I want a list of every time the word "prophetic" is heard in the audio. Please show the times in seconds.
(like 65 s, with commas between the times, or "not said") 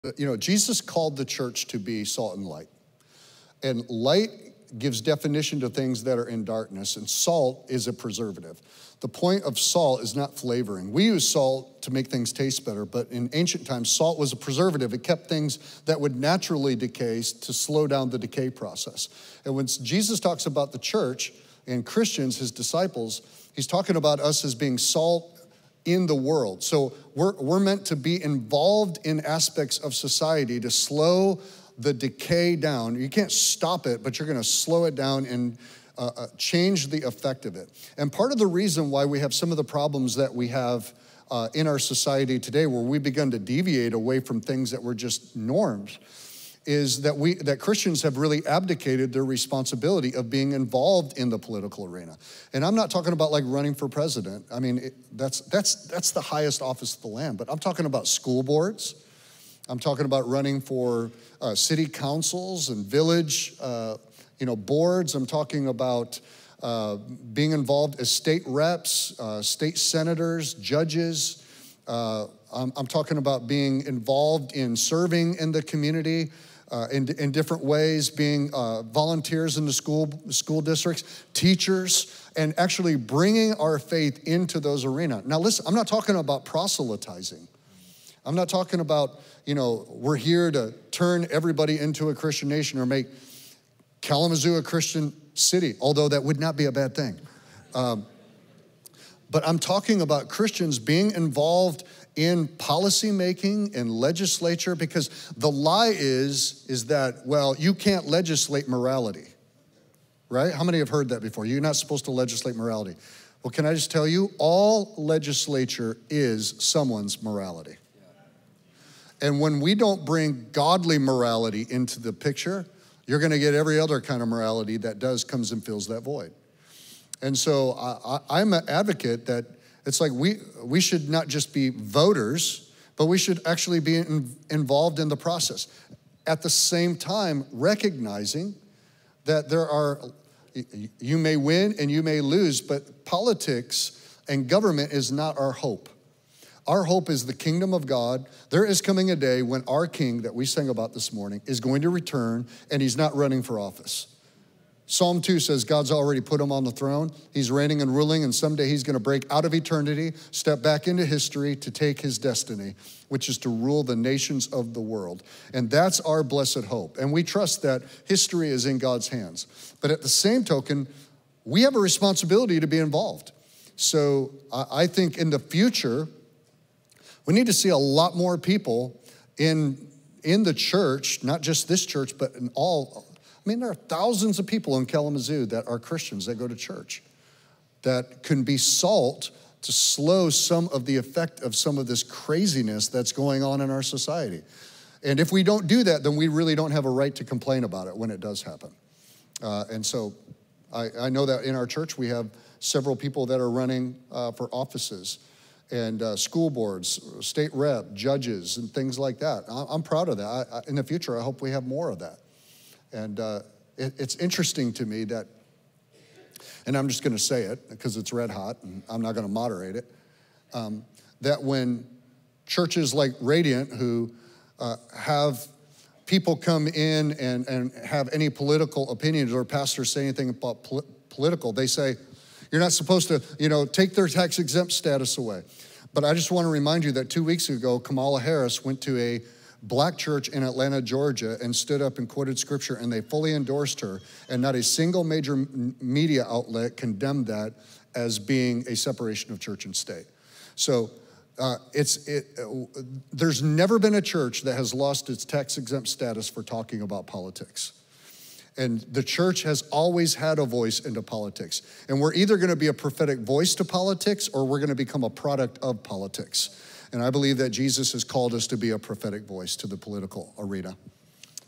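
262 s, 268 s.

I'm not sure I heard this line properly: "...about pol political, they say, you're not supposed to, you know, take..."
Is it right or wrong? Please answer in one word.
right.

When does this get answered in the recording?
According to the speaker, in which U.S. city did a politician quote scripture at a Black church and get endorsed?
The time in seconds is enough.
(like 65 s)
240 s.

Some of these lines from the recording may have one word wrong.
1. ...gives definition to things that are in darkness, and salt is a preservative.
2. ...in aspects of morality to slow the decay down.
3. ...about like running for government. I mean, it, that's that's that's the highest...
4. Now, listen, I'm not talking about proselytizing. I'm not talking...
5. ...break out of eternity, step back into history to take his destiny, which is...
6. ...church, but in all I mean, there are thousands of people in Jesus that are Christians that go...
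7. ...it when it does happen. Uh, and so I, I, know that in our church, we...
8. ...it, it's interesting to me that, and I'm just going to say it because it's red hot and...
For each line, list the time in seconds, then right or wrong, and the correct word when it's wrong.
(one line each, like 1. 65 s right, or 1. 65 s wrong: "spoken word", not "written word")
1. 4 s right
2. 29 s wrong: "society", not "morality"
3. 53 s wrong: "president", not "government"
4. 85 s right
5. 158 s right
6. 181 s wrong: "Kalamazoo", not "Jesus"
7. 197 s right
8. 213 s right.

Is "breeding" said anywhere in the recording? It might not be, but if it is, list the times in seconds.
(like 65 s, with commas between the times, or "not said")
not said.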